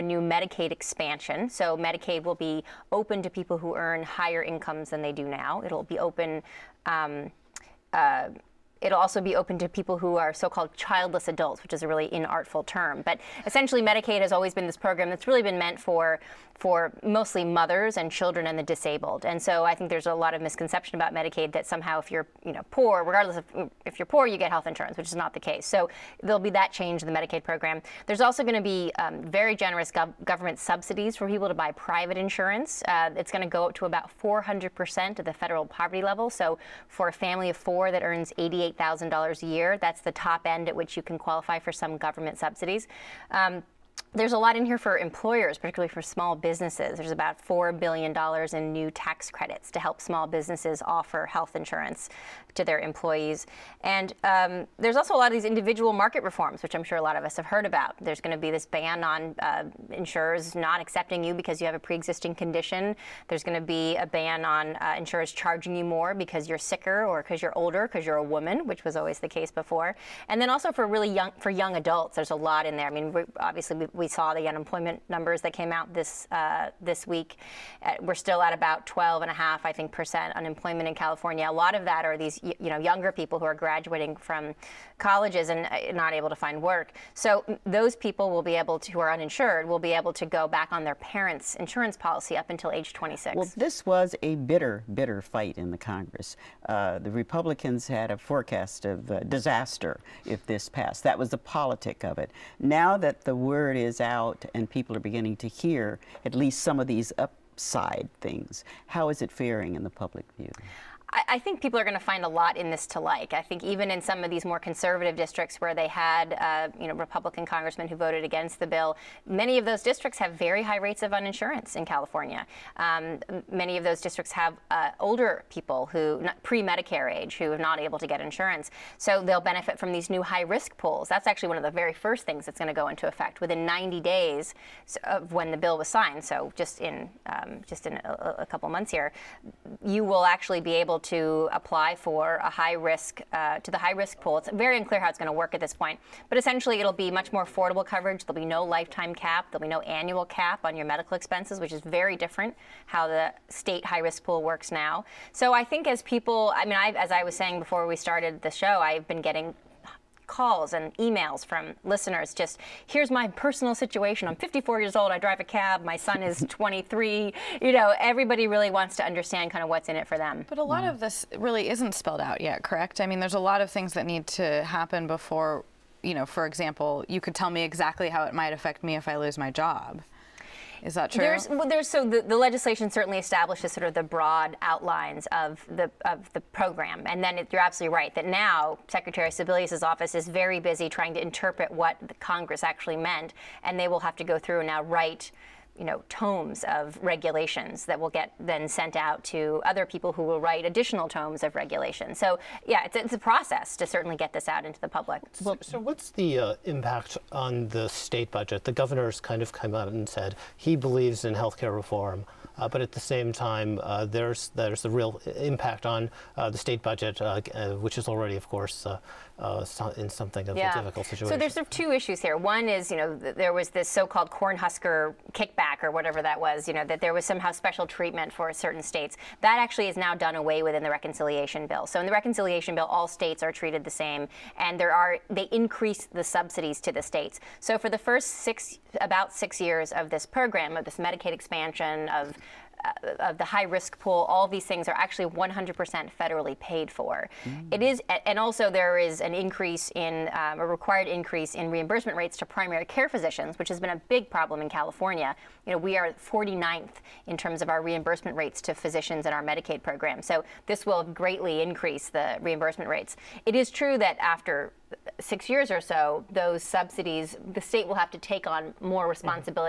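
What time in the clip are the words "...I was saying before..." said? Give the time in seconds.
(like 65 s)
157 s.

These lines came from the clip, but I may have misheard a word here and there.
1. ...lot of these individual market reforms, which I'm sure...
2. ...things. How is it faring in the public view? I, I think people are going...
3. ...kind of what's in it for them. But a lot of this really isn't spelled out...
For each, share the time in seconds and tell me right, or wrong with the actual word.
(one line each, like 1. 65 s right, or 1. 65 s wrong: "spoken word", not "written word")
1. 55 s right
2. 108 s right
3. 169 s right.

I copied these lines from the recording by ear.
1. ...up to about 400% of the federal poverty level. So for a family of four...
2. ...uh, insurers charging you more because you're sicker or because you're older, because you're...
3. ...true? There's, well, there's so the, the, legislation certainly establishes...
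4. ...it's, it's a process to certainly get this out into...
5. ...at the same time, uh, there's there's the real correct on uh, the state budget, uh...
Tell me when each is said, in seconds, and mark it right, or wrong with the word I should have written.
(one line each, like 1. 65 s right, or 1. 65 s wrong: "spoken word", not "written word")
1. 33 s right
2. 64 s right
3. 181 s right
4. 202 s right
5. 212 s wrong: "impact", not "correct".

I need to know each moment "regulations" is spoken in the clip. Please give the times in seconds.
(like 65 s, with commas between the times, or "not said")
197 s, 201 s.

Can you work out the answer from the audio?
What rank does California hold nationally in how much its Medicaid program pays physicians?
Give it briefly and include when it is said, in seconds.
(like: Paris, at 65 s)
49th, at 256 s.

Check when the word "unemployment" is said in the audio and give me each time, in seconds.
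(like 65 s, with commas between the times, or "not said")
74 s, 80 s.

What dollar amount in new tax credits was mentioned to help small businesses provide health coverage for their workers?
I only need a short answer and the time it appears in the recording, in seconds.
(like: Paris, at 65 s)
$4 billion, at 47 s.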